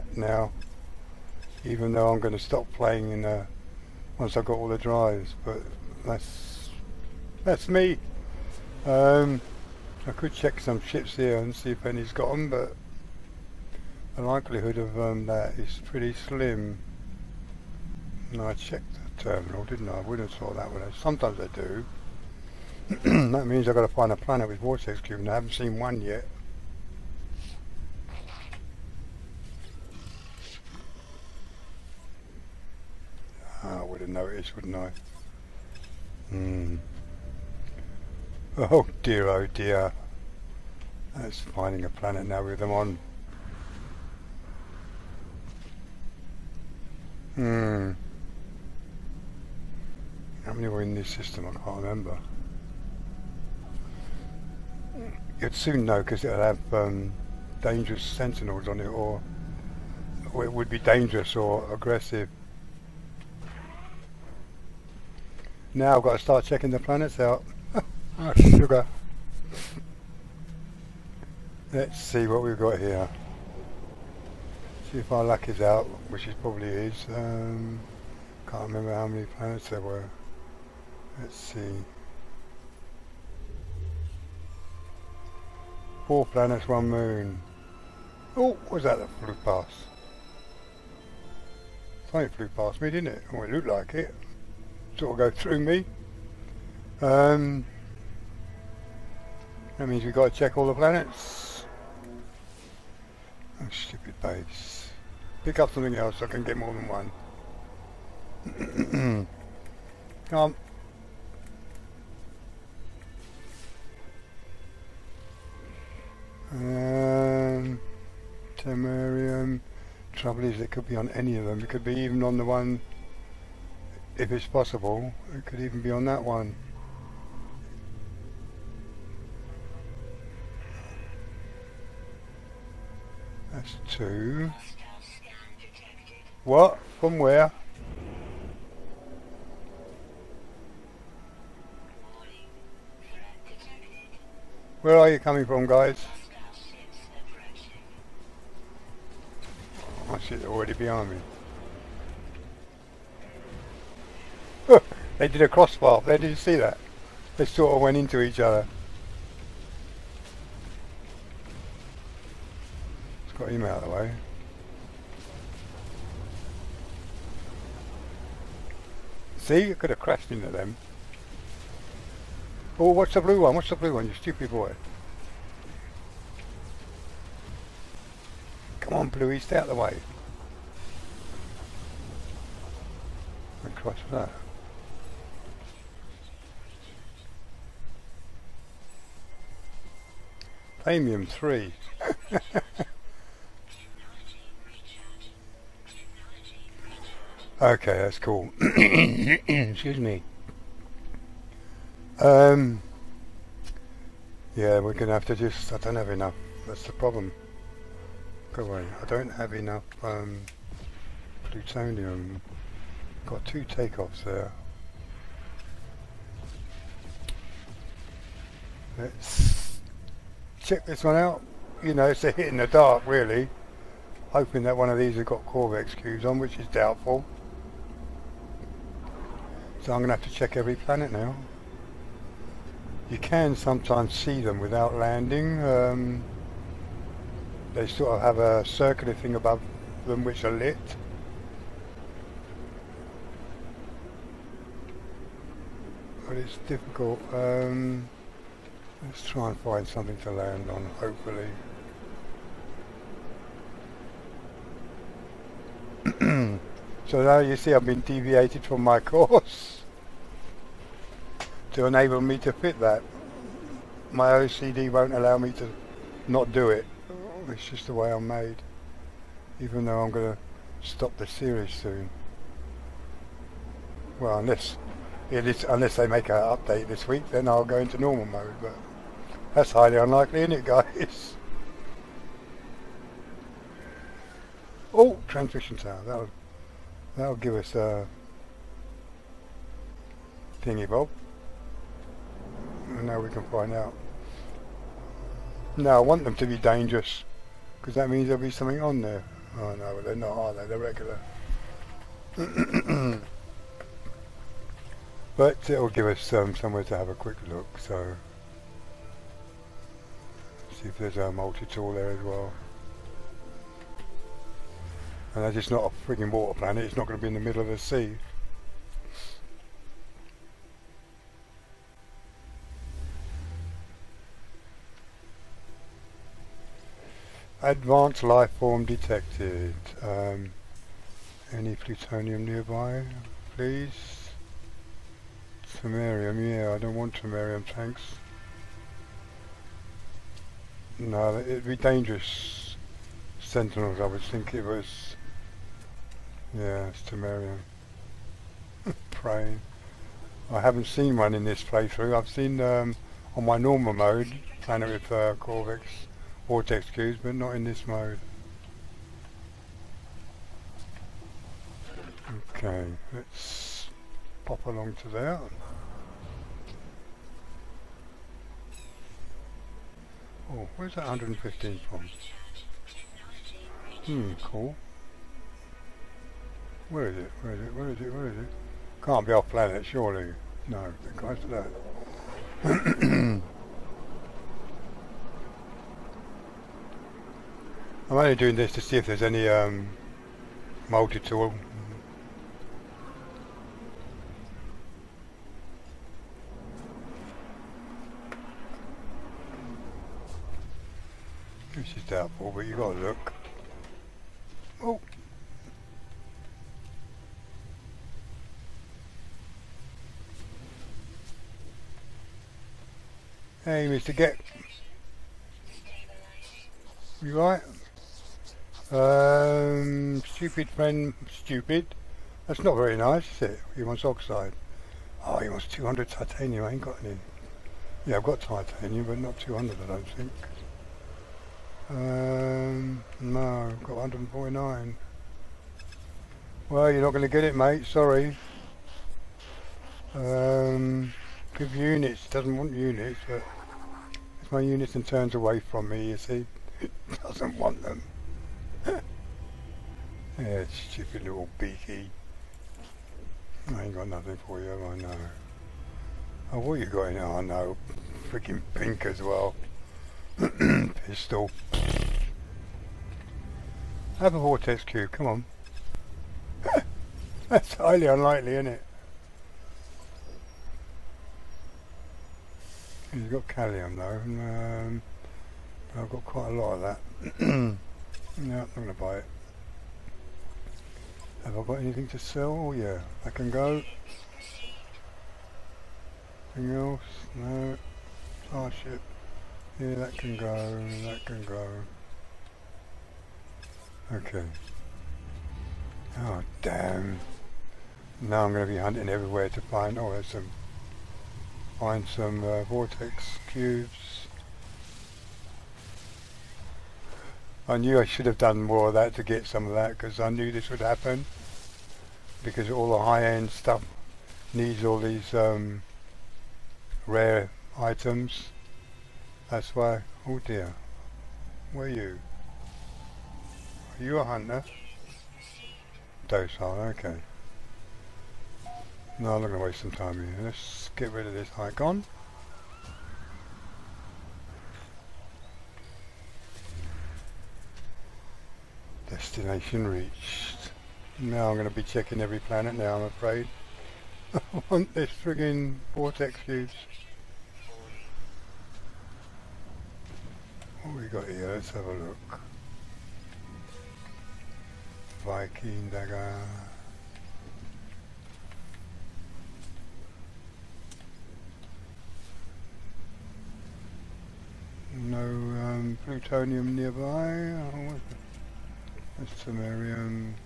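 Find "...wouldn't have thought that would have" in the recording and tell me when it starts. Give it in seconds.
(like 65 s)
20 s.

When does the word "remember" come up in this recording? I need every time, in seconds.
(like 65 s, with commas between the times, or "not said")
51 s, 78 s.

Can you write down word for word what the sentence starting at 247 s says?
Um, let's try and find something to land on, hopefully.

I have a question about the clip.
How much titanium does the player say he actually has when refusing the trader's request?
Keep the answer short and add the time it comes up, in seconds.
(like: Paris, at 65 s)
149, at 433 s.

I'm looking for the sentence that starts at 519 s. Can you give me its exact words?
That's why, oh dear, where you?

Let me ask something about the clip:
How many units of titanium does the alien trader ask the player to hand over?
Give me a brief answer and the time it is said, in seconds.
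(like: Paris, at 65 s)
200, at 425 s.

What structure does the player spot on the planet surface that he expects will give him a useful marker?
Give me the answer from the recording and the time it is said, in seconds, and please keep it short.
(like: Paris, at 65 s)
transmission tower, at 285 s.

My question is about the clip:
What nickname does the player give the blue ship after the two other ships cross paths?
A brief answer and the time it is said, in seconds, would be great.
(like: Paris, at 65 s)
Bluey, at 179 s.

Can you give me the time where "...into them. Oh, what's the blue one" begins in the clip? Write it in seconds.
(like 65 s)
170 s.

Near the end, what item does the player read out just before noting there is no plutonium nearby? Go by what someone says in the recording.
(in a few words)
Viking dagger.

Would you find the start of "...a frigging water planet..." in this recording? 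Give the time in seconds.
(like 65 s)
315 s.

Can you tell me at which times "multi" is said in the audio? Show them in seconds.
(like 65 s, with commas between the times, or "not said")
311 s, 390 s.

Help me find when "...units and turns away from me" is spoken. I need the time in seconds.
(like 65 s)
444 s.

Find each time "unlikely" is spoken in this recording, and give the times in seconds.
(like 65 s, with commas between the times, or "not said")
279 s, 468 s.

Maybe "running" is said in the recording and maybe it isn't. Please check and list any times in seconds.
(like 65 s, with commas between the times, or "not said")
not said.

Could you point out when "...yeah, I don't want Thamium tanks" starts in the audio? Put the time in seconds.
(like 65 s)
336 s.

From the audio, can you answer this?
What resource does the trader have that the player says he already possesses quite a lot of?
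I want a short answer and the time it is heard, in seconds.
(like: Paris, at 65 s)
Kalium, at 473 s.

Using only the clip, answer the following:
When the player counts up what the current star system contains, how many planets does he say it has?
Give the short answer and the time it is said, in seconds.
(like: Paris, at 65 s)
4, at 86 s.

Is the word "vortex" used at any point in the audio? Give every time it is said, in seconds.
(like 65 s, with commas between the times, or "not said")
24 s, 356 s, 464 s, 502 s, 545 s.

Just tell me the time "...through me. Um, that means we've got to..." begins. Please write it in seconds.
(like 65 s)
95 s.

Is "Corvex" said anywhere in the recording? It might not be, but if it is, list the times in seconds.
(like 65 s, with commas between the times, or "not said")
225 s, 355 s.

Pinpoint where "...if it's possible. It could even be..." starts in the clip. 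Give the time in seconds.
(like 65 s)
124 s.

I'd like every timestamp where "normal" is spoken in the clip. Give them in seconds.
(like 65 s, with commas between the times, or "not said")
277 s, 353 s.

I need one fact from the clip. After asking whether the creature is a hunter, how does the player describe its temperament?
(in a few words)
Docile.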